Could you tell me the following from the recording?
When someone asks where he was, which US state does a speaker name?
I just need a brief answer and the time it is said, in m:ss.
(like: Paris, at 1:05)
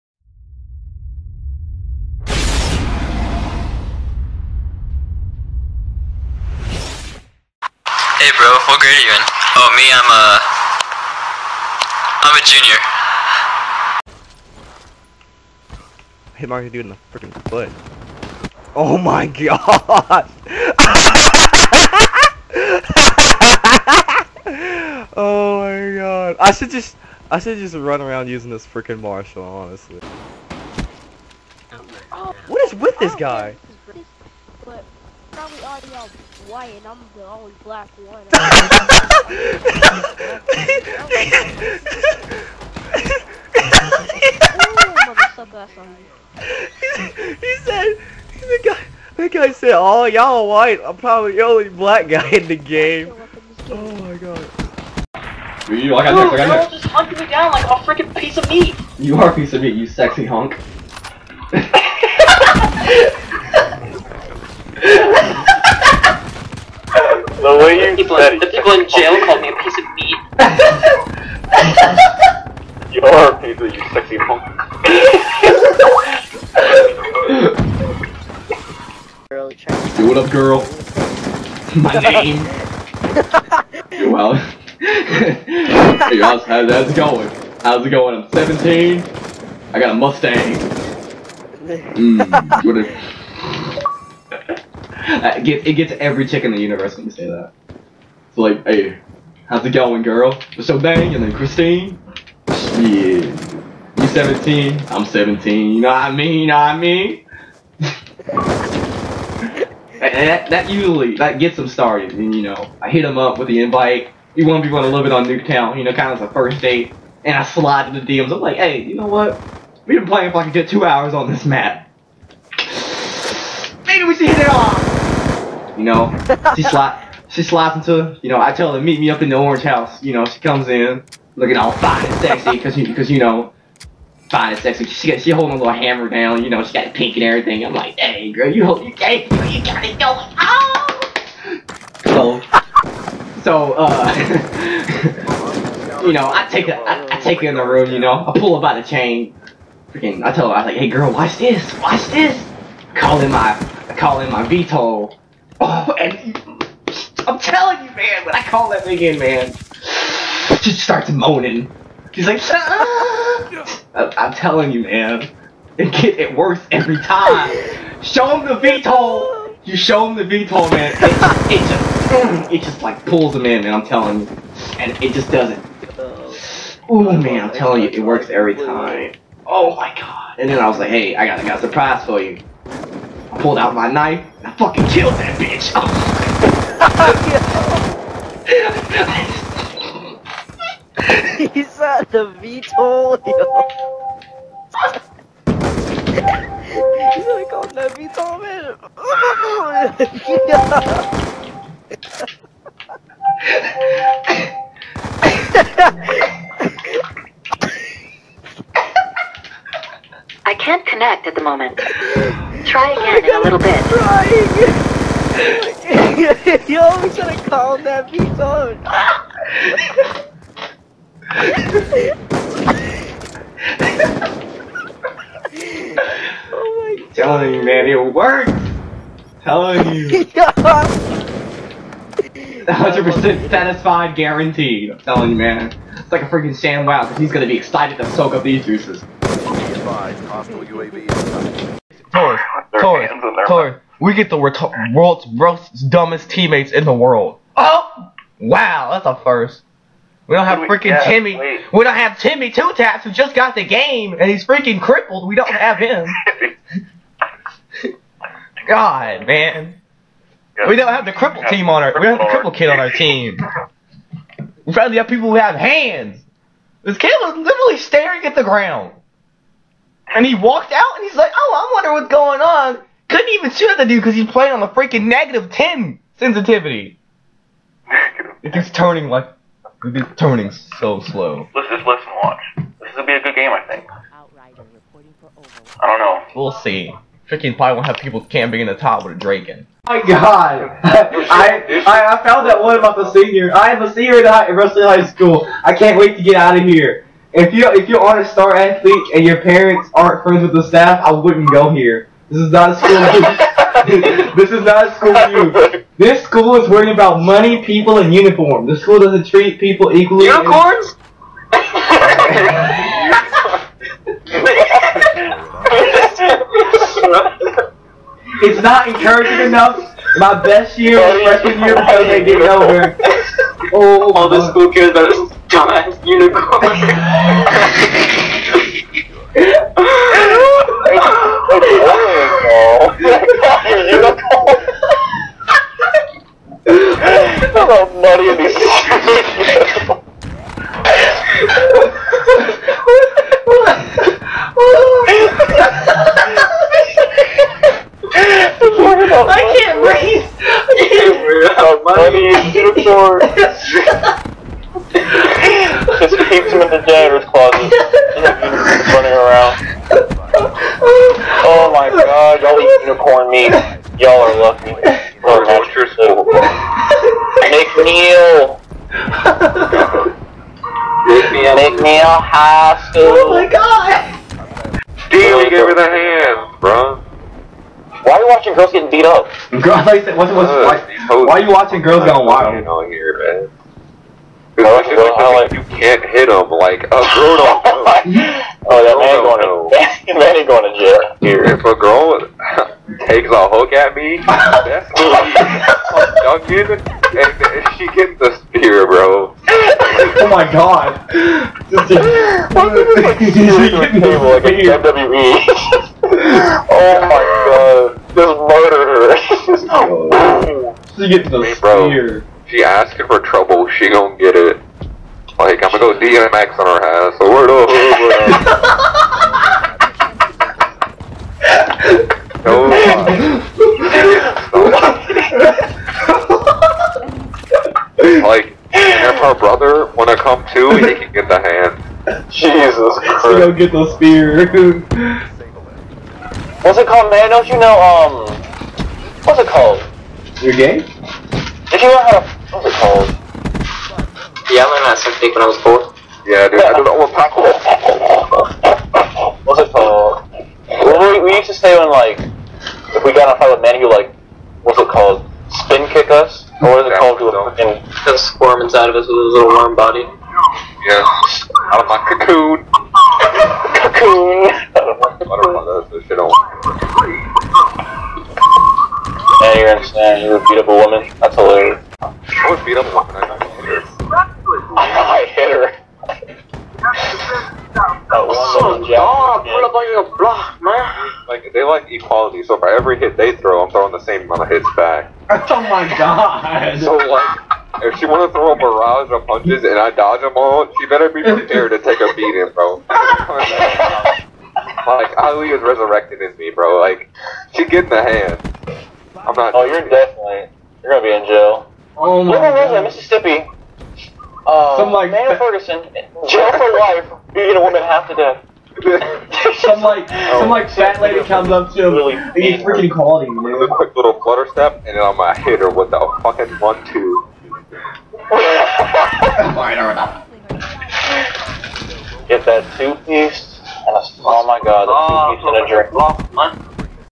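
Mississippi, at 8:22.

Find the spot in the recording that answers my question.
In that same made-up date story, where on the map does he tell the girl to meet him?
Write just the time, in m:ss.
2:09.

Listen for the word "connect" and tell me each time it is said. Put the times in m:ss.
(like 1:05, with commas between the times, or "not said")
3:30.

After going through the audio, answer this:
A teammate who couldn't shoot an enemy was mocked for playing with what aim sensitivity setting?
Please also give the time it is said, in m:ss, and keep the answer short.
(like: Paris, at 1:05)
-10, at 4:35.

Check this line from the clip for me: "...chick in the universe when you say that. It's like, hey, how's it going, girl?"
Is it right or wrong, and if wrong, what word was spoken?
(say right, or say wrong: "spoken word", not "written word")
right.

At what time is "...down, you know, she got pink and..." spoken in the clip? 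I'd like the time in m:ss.
2:16.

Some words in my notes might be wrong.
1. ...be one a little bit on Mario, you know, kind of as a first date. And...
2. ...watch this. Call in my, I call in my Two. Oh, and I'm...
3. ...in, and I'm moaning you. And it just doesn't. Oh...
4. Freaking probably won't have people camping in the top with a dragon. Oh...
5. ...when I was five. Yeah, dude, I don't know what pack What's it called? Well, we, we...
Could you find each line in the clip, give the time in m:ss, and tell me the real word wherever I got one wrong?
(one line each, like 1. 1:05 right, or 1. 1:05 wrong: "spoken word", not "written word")
1. 1:54 wrong: "Nuketown", not "Mario"
2. 2:31 wrong: "VTOL", not "Two"
3. 2:53 wrong: "telling", not "moaning"
4. 4:47 right
5. 7:25 wrong: "four", not "five".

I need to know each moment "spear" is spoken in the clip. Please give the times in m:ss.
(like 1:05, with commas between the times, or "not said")
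6:38, 6:51, 7:13.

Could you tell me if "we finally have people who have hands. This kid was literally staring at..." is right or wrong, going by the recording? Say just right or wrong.
right.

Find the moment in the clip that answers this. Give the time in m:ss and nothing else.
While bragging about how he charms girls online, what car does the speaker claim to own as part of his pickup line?
1:29.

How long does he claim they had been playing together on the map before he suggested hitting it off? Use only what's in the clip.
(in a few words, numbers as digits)
2 hours.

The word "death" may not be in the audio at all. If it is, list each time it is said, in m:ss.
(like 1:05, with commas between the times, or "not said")
8:28.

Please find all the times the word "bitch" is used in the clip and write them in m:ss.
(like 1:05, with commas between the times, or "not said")
3:05, 3:38.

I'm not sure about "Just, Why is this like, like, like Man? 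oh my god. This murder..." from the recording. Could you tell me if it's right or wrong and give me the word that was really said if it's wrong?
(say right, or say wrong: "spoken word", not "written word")
wrong: "WWE", not "Man".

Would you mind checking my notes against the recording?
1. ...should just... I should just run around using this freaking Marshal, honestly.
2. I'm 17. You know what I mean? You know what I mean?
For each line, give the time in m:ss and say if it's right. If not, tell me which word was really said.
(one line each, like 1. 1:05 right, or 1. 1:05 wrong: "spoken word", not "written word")
1. 0:26 right
2. 1:44 right.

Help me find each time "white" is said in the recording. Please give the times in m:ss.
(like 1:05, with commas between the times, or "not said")
0:36, 0:50.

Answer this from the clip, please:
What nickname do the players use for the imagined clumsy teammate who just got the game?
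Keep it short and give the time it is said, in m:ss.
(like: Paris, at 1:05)
Timmy Two Taps, at 4:12.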